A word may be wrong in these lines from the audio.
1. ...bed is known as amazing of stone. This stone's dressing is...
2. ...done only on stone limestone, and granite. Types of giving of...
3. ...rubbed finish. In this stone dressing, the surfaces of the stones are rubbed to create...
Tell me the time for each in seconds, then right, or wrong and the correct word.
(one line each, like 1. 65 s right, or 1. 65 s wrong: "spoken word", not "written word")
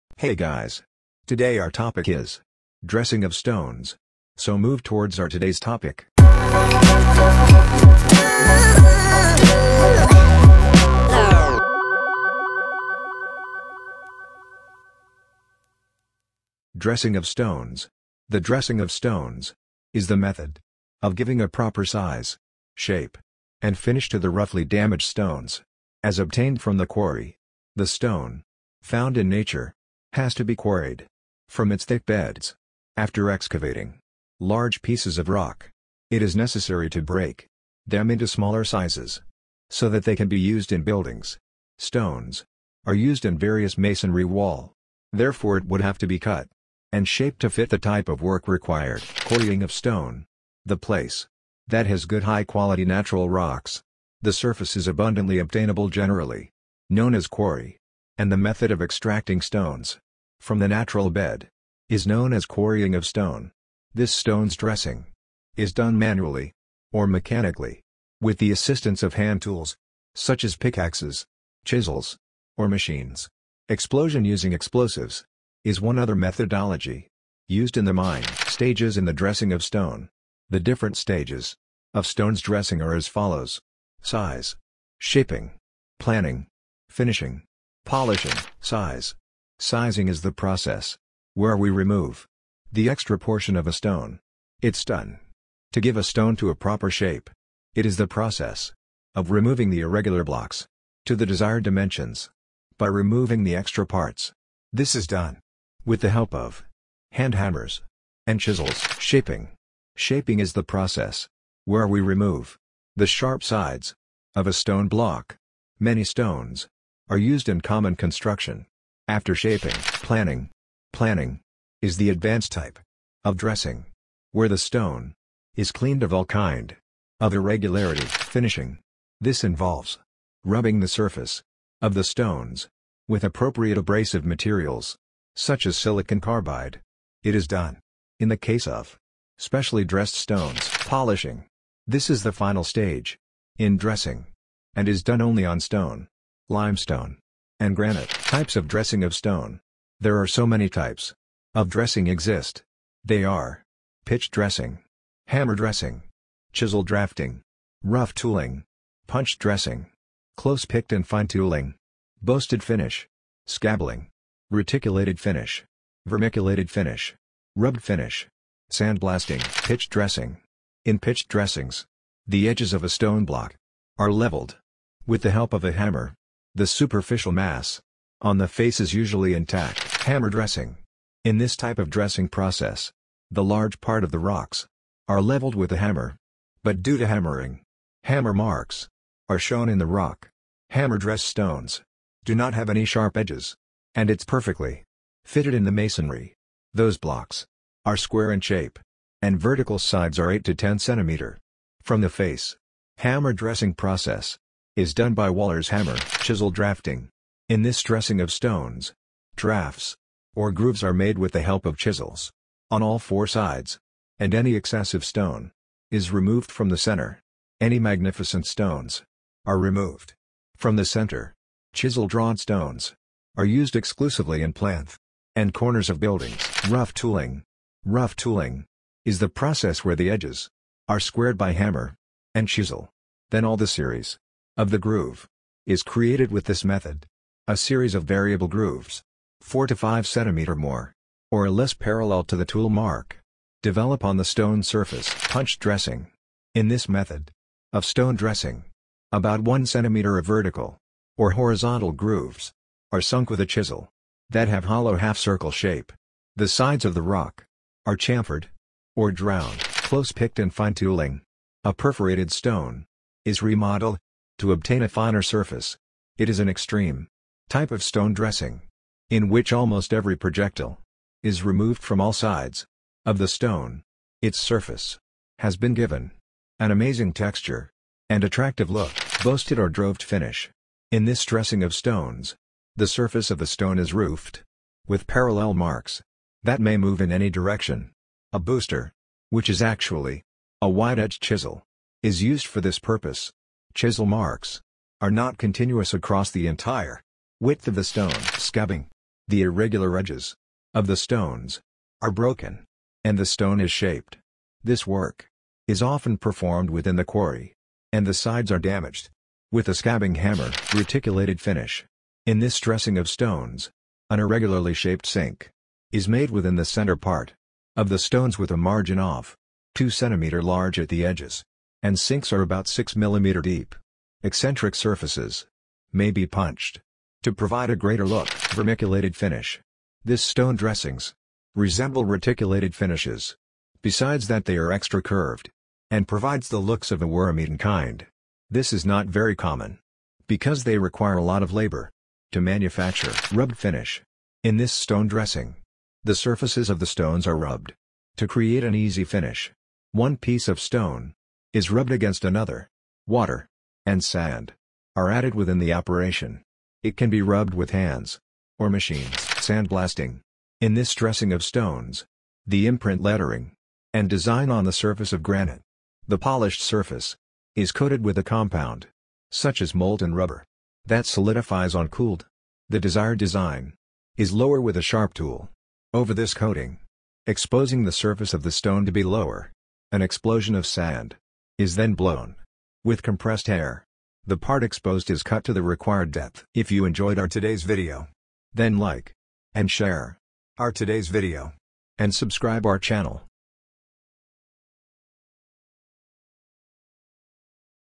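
1. 61 s wrong: "quarrying", not "amazing"
2. 145 s wrong: "dressing", not "giving"
3. 343 s right.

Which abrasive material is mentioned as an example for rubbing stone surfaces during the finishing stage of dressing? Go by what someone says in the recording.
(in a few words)
silicon carbide.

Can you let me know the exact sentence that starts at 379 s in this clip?
An explosion of sand is then blown.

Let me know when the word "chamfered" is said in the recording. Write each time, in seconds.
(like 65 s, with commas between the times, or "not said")
257 s.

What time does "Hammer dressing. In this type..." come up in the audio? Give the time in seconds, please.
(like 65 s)
180 s.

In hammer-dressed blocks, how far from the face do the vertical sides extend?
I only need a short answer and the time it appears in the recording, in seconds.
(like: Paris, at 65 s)
8 to 10 centimeters, at 200 s.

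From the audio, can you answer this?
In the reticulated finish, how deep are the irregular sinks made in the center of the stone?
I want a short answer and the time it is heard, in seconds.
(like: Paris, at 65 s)
6 mm, at 322 s.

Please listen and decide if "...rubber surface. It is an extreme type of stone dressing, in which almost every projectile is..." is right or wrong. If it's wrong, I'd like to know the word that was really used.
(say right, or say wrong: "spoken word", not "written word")
wrong: "finer", not "rubber".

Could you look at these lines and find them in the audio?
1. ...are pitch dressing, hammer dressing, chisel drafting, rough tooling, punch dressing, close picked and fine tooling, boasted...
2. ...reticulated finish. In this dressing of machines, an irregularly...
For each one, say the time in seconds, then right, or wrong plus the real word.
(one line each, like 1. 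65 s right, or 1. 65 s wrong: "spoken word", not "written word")
1. 153 s right
2. 310 s wrong: "stones", not "machines".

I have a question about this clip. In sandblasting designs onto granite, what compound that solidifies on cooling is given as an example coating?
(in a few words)
molten rubber.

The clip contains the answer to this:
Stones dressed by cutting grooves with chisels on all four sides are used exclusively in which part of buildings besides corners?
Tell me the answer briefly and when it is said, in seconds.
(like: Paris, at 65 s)
plinth, at 224 s.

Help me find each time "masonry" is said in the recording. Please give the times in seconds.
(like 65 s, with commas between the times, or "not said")
43 s, 195 s.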